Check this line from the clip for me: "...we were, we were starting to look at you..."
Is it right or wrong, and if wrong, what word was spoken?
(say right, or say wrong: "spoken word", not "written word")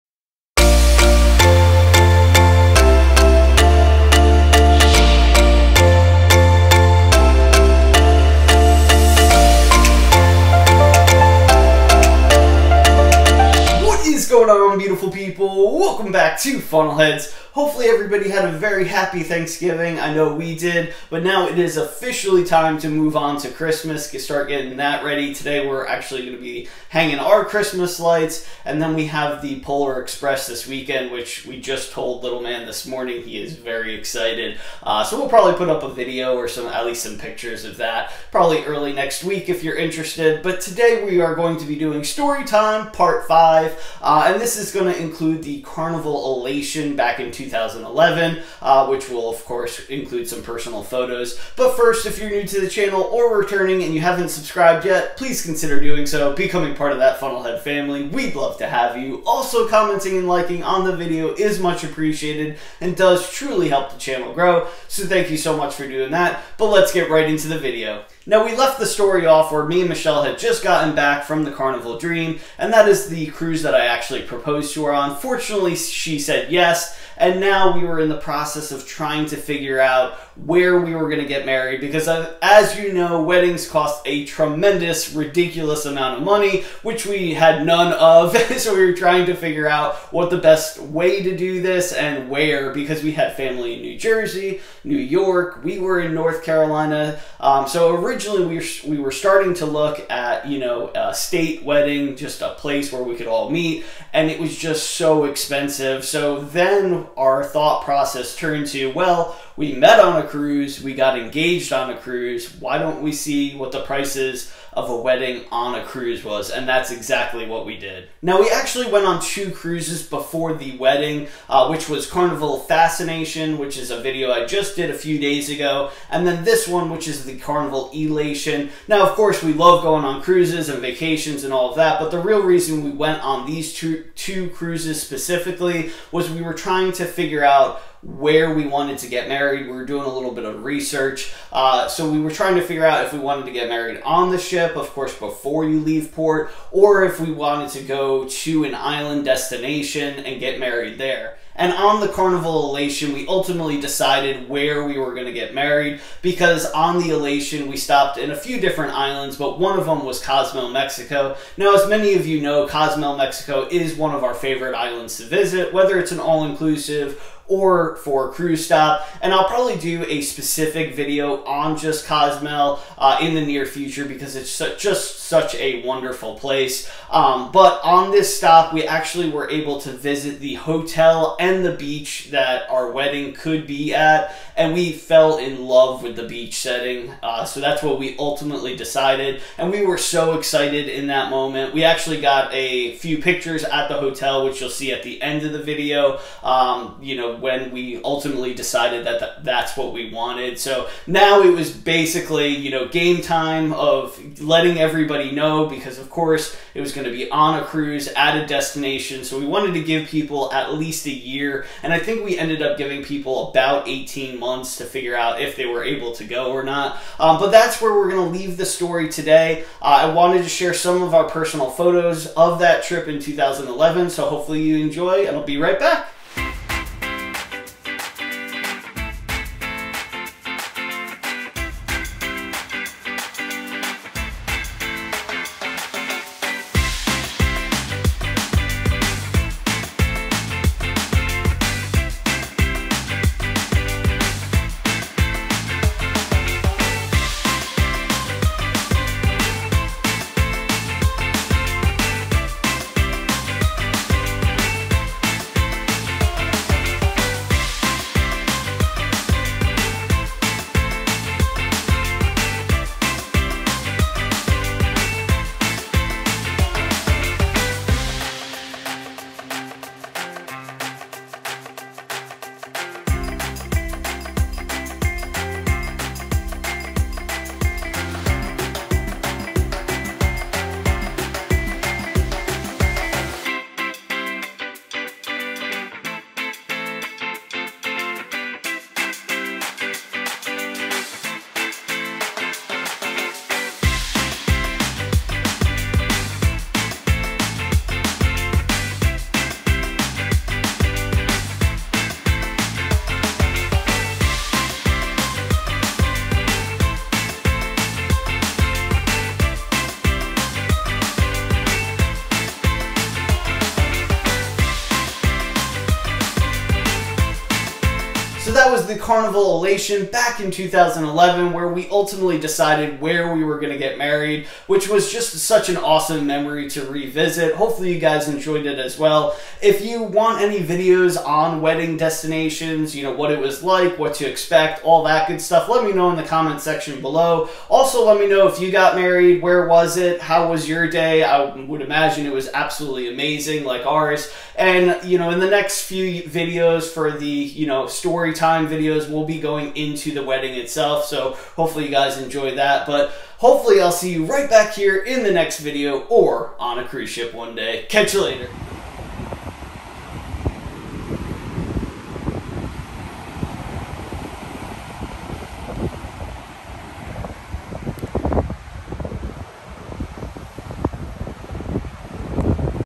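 right.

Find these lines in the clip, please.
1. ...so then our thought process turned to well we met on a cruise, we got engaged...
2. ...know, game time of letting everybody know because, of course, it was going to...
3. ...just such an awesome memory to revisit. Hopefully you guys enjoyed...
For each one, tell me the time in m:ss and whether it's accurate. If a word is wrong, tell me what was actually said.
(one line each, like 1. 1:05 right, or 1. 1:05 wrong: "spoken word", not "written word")
1. 1:46 right
2. 3:22 right
3. 5:25 right.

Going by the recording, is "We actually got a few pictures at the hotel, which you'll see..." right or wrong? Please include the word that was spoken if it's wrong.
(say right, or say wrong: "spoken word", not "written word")
right.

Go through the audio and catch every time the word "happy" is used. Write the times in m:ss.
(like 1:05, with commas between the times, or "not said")
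0:18.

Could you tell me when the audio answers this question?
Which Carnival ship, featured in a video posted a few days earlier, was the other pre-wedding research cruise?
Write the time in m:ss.
2:02.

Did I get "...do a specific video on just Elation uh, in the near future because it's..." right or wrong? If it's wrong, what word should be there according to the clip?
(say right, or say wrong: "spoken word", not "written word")
wrong: "Cozumel", not "Elation".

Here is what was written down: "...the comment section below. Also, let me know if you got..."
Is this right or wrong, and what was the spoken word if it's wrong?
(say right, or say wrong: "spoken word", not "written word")
right.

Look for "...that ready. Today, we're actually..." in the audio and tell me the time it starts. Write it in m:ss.
0:24.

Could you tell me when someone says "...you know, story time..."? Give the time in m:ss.
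5:47.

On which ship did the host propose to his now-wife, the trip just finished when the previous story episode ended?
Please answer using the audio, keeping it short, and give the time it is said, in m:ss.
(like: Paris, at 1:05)
Carnival Dream, at 1:11.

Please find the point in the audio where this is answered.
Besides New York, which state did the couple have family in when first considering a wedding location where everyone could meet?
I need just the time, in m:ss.
1:33.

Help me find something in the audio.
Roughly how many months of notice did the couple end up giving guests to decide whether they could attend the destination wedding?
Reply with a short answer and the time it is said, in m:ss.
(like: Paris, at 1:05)
18, at 3:33.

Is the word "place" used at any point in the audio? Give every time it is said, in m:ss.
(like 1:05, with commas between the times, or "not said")
1:42, 2:56.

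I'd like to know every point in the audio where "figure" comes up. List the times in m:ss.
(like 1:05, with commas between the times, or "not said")
1:19, 1:29, 2:17, 2:22, 3:34.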